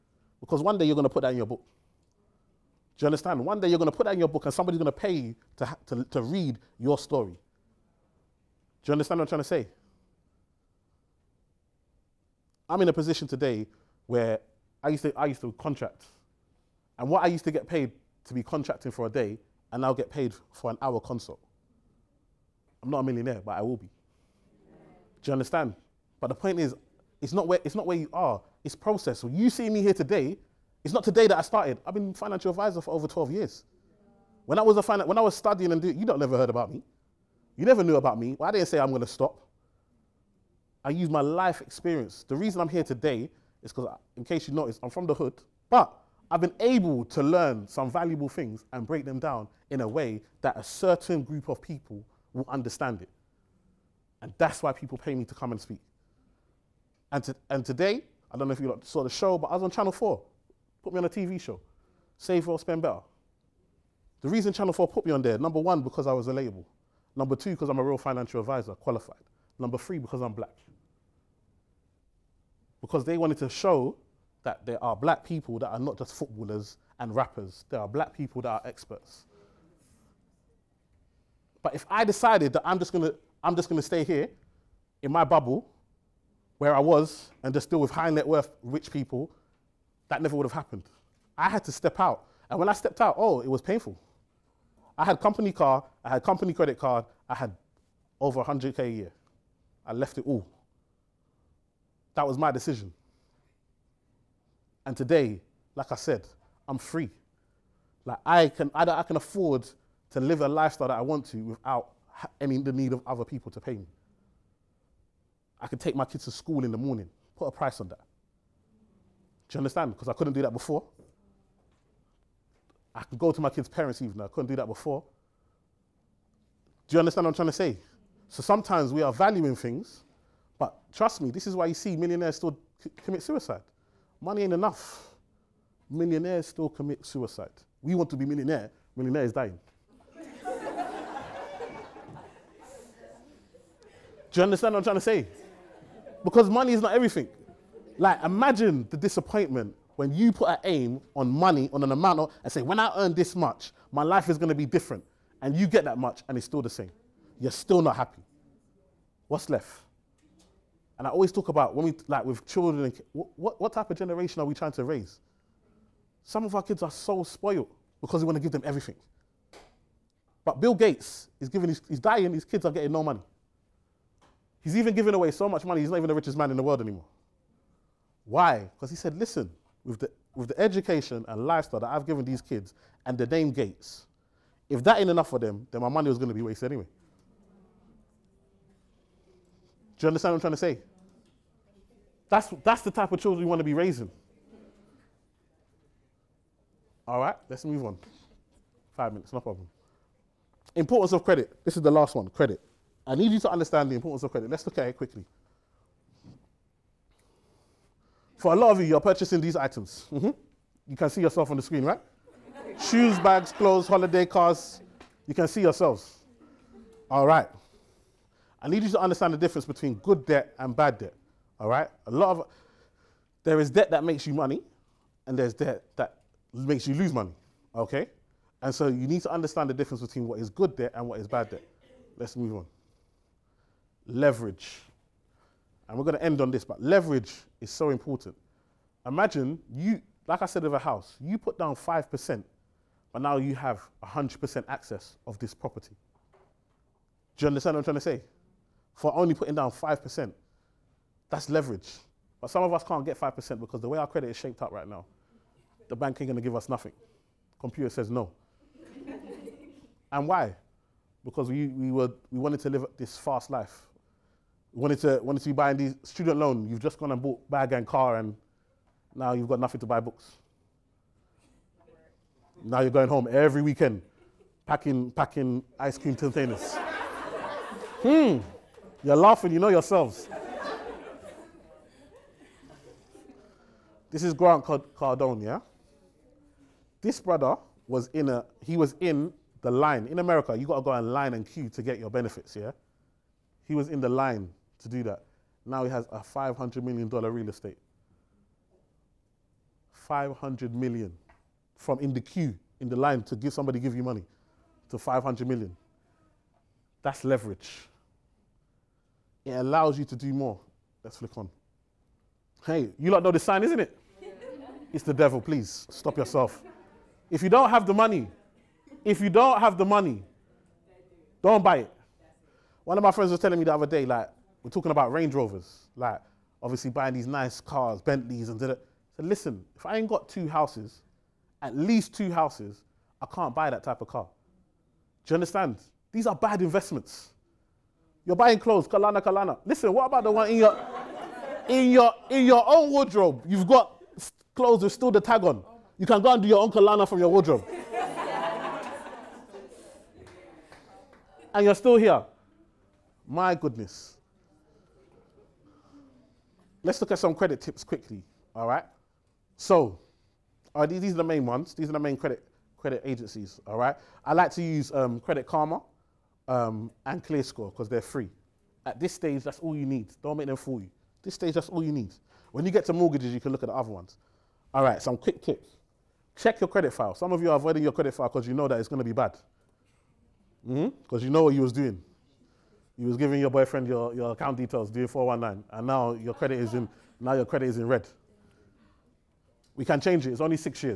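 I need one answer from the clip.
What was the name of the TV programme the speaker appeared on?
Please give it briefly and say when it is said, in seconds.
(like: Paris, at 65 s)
Save or Spend Better, at 62 s.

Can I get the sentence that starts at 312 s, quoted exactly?
Hey, you lot know the sign, isn't it?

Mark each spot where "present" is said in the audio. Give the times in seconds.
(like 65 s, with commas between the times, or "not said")
not said.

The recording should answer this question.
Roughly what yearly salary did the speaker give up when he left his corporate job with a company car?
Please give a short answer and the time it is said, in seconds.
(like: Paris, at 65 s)
100K, at 98 s.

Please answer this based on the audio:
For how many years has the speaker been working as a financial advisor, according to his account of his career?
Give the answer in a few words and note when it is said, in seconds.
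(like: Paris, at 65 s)
12 years, at 32 s.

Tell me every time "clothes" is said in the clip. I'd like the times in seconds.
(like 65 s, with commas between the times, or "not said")
213 s, 338 s, 344 s.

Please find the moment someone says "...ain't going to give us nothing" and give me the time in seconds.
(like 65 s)
256 s.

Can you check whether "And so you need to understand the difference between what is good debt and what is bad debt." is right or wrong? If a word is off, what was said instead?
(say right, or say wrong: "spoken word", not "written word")
right.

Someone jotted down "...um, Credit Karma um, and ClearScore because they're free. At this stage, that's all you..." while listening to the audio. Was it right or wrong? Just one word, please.
right.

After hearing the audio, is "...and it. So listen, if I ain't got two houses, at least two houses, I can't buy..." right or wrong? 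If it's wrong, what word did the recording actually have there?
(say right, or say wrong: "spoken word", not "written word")
right.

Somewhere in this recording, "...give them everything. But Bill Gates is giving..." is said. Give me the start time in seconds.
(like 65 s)
168 s.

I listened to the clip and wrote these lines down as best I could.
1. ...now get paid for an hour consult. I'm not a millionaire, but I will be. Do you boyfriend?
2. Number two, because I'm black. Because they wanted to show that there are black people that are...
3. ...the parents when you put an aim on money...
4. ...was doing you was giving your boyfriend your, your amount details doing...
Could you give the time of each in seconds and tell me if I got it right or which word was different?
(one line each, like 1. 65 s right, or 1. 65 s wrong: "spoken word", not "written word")
1. 19 s wrong: "understand", not "boyfriend"
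2. 69 s wrong: "three", not "two"
3. 148 s wrong: "disappointment", not "parents"
4. 381 s wrong: "account", not "amount".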